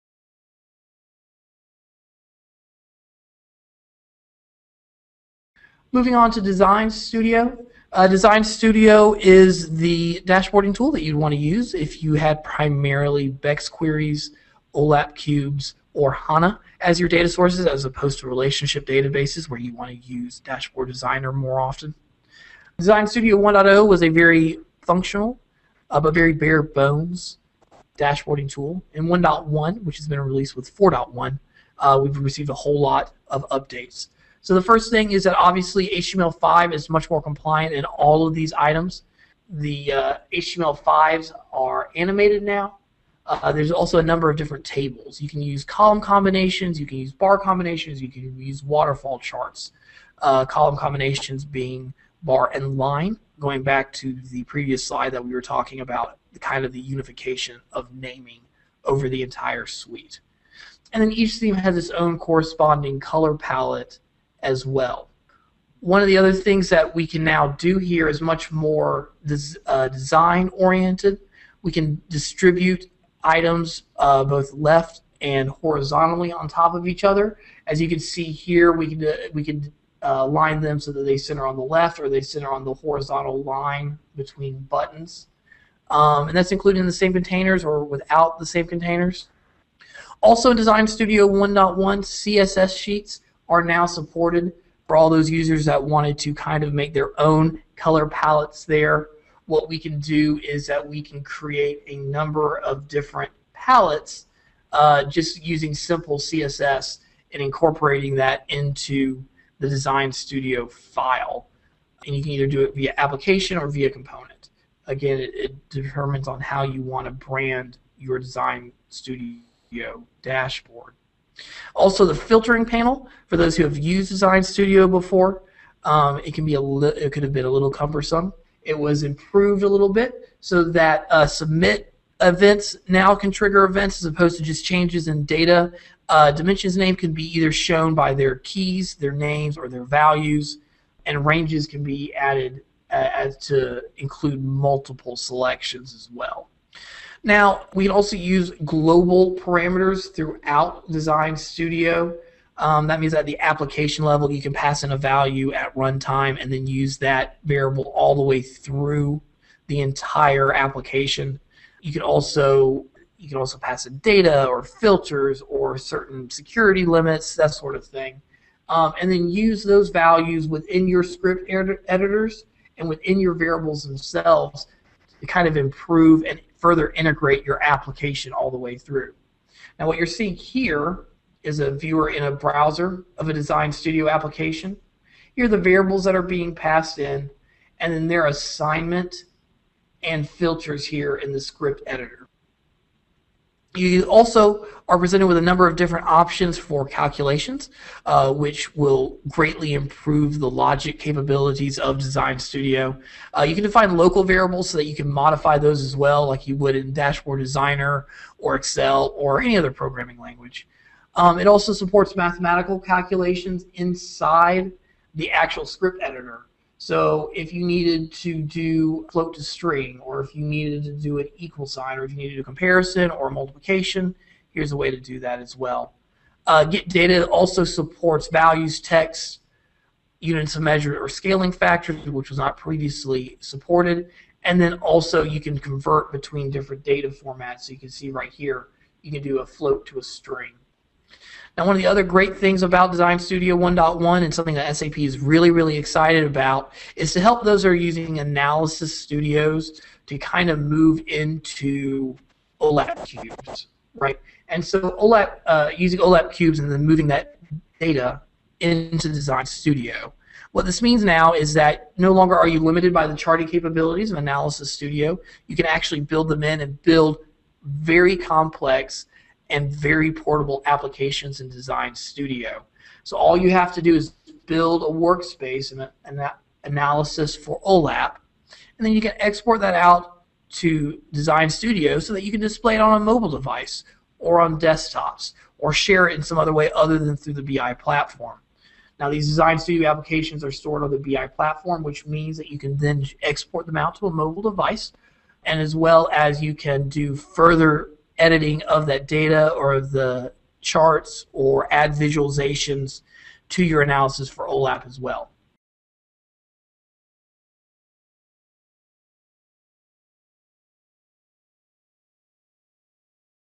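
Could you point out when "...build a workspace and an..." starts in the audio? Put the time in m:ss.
4:34.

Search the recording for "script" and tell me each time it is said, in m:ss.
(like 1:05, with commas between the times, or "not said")
2:51, 3:11, 3:35.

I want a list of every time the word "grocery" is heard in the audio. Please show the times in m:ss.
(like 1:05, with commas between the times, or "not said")
not said.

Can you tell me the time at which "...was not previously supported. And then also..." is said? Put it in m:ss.
3:52.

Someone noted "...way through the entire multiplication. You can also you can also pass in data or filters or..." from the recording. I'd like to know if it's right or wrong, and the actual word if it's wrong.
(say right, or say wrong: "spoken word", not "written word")
wrong: "application", not "multiplication".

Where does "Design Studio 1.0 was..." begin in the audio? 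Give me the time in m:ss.
0:22.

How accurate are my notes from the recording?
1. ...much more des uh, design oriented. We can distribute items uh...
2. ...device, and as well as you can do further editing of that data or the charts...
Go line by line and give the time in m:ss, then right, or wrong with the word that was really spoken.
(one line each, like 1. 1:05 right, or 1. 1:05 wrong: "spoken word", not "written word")
1. 1:08 right
2. 4:54 right.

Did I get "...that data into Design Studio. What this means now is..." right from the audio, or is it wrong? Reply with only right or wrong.
right.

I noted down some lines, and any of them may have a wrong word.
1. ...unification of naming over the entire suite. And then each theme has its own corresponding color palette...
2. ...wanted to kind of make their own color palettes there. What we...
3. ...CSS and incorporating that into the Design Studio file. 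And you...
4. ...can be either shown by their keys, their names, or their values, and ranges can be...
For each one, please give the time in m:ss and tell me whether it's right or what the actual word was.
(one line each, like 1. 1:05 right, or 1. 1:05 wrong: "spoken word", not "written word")
1. 0:56 right
2. 1:35 right
3. 1:46 right
4. 2:16 right.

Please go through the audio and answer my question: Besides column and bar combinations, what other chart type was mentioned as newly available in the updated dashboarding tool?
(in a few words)
Waterfall charts.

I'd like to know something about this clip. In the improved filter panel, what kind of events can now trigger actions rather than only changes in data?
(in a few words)
Submit events.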